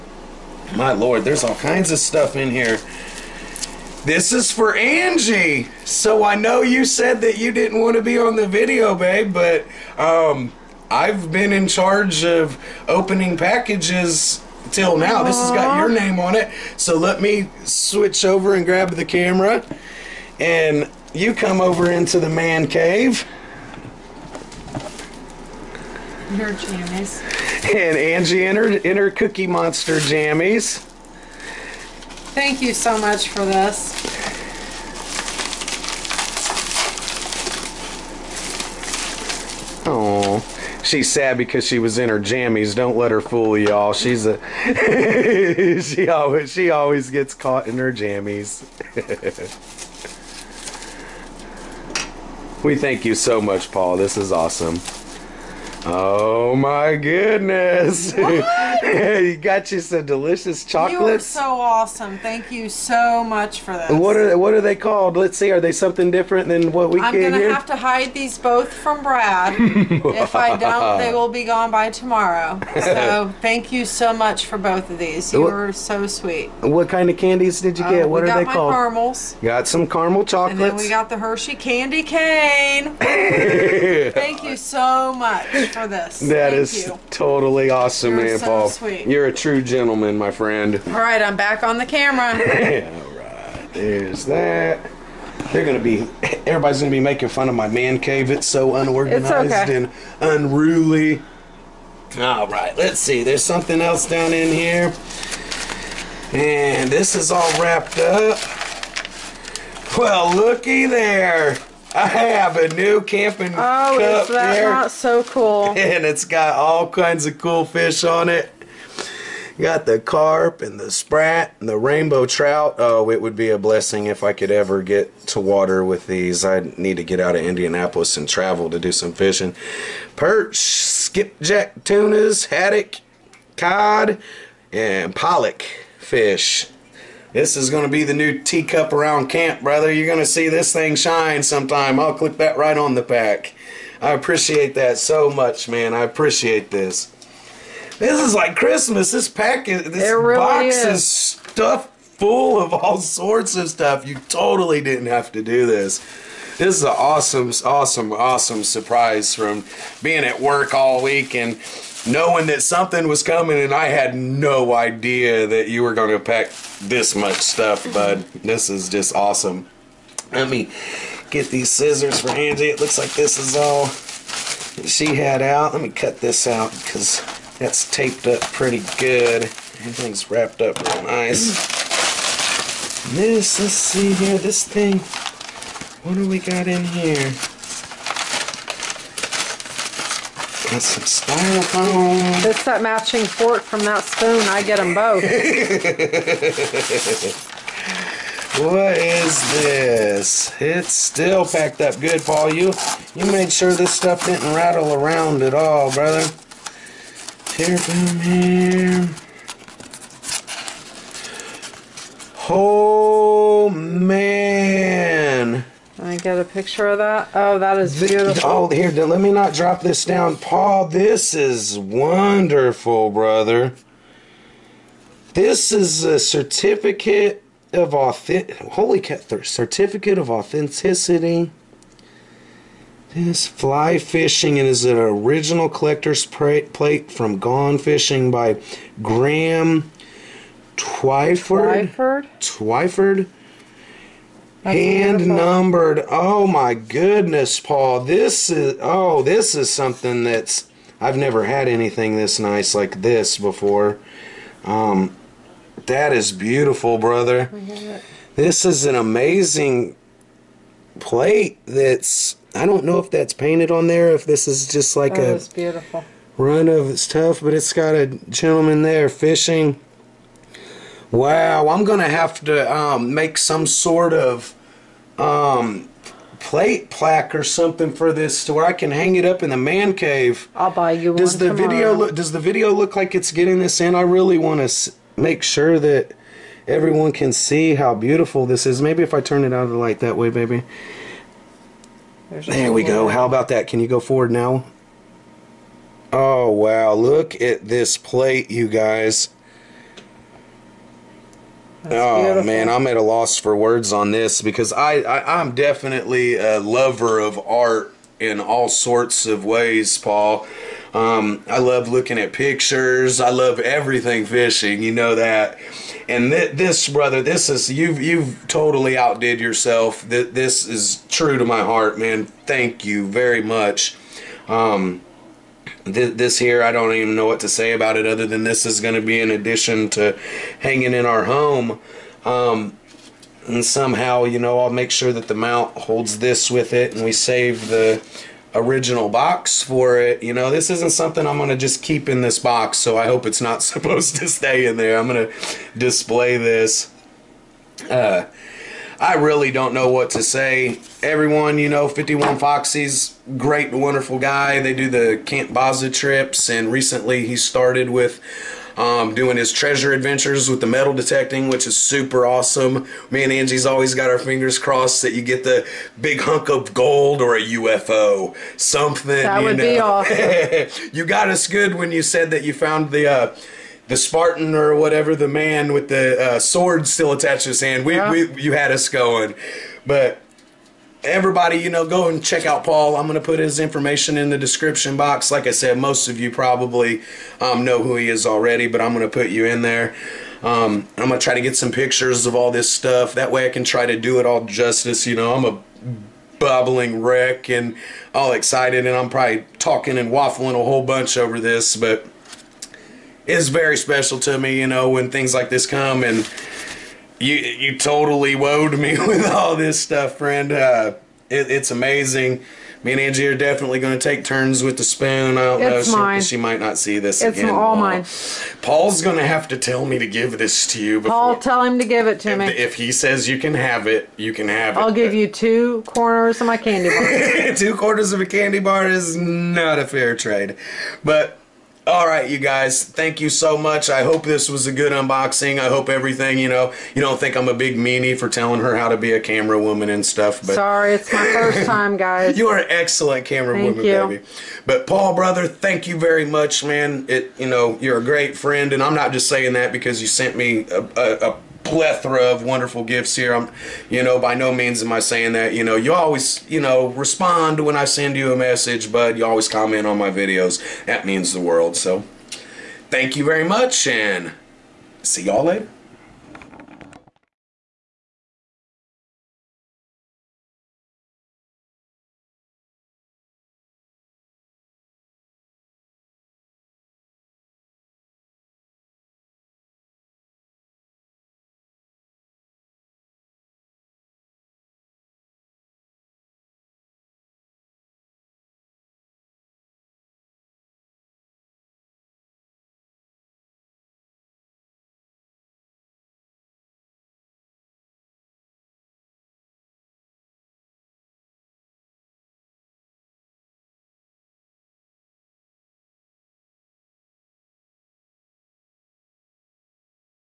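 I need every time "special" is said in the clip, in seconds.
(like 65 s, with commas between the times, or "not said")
403 s.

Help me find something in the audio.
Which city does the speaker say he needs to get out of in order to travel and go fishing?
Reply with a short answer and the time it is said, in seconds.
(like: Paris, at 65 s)
Indianapolis, at 127 s.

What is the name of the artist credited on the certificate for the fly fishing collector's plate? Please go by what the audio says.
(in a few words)
Graham Twyford.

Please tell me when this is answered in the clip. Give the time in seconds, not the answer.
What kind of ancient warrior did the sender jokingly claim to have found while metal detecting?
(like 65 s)
373 s.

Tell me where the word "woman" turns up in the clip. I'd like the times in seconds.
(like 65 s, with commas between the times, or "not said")
439 s, 443 s.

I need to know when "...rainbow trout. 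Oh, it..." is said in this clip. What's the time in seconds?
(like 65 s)
121 s.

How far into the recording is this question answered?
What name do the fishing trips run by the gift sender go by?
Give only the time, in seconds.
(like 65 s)
355 s.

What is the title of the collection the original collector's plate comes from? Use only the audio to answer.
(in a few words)
Gone Fishing.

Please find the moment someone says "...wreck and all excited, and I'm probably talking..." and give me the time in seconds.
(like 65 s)
397 s.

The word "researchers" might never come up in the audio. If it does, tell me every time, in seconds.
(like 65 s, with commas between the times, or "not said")
not said.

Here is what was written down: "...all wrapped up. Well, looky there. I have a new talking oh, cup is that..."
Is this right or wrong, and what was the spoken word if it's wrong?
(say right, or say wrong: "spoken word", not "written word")
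wrong: "camping", not "talking".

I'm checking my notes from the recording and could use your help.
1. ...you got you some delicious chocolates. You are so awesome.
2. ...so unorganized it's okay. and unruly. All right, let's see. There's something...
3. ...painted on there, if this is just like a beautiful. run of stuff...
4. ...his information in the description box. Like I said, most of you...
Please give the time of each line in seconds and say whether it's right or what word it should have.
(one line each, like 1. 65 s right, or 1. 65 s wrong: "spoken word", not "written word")
1. 58 s right
2. 98 s right
3. 263 s right
4. 383 s right.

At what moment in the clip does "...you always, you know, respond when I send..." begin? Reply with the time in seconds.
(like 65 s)
455 s.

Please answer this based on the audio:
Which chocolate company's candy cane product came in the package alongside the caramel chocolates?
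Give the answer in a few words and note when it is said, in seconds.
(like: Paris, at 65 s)
Hershey, at 81 s.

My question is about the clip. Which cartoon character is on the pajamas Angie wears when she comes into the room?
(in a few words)
Cookie Monster.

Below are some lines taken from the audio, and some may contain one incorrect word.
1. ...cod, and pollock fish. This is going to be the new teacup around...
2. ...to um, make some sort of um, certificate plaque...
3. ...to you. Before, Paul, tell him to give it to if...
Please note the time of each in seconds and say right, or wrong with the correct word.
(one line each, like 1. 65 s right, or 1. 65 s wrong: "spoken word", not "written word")
1. 133 s right
2. 272 s wrong: "plate", not "certificate"
3. 420 s right.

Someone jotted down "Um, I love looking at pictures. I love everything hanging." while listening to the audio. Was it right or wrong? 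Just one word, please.
wrong.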